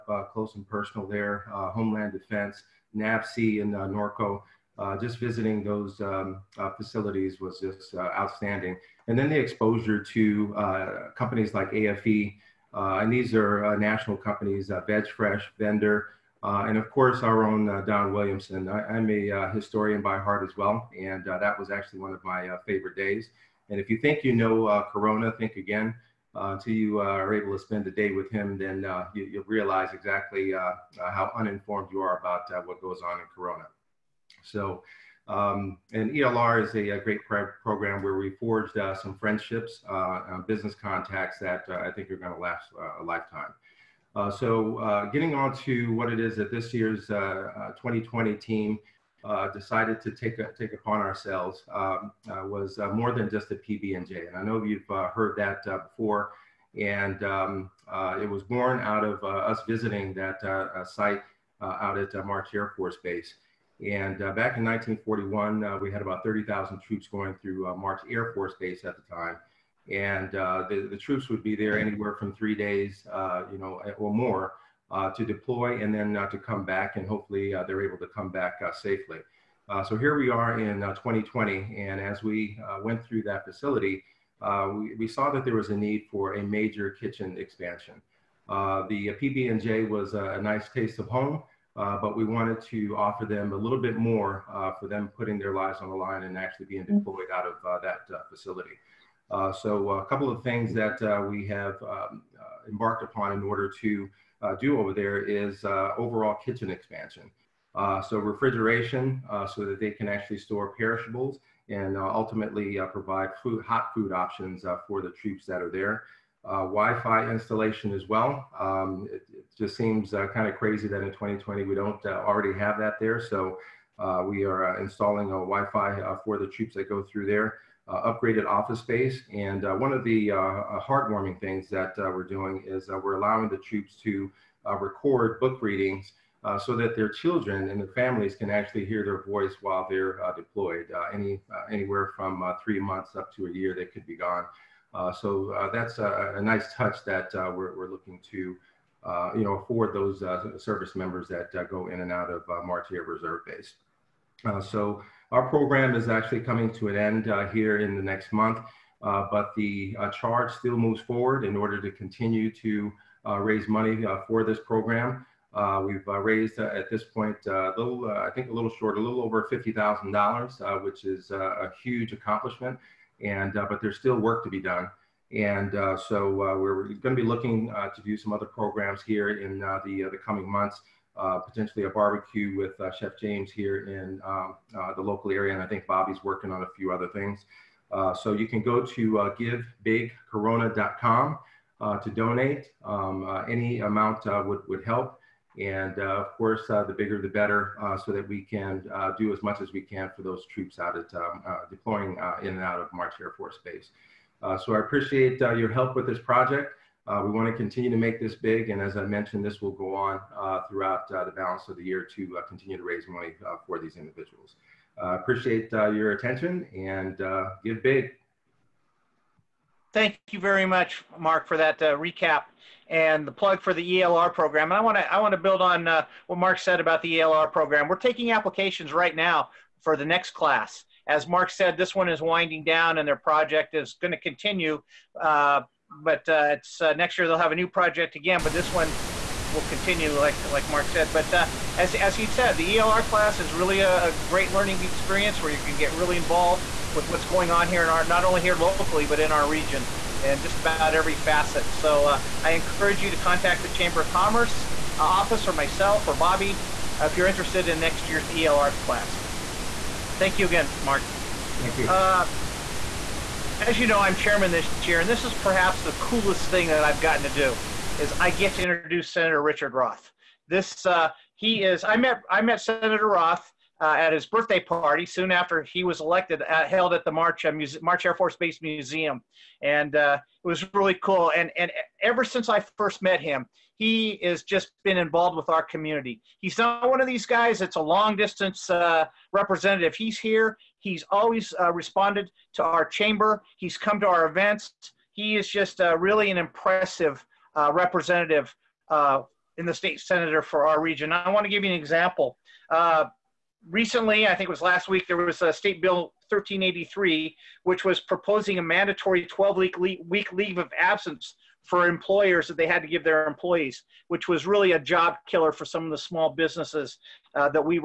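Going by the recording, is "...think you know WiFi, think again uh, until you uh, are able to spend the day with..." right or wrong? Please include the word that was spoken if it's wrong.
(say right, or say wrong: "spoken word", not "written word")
wrong: "Corona", not "WiFi".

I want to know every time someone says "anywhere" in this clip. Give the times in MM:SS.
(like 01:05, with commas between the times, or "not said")
01:11, 02:21.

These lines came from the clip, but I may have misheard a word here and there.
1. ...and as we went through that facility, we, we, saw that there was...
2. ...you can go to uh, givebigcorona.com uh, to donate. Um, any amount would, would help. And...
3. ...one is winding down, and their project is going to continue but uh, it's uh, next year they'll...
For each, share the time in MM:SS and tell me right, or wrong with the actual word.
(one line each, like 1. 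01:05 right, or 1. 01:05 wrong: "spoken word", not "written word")
1. 01:21 right
2. 03:08 right
3. 03:51 right.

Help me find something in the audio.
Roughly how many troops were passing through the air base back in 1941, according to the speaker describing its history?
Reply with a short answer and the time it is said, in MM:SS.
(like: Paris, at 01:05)
30,000, at 01:06.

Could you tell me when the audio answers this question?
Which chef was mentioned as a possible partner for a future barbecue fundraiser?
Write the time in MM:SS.
03:02.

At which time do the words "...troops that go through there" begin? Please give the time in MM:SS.
02:06.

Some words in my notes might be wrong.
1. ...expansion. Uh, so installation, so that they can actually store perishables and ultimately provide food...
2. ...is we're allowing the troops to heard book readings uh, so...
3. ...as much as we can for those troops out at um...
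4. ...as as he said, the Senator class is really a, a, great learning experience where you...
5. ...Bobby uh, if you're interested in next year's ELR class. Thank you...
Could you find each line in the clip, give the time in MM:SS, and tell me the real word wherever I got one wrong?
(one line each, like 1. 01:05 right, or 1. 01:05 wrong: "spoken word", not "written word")
1. 01:46 wrong: "refrigeration", not "installation"
2. 02:12 wrong: "record", not "heard"
3. 03:19 right
4. 04:01 wrong: "ELR", not "Senator"
5. 04:16 right.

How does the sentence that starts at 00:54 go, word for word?
And I know you've uh, heard that uh, before.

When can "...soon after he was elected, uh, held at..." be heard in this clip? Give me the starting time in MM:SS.
04:35.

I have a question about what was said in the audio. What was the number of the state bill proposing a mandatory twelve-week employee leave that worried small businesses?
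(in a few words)
1383.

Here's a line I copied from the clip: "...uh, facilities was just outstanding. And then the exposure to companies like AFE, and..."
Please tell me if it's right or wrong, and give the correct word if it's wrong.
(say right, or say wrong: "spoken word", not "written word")
right.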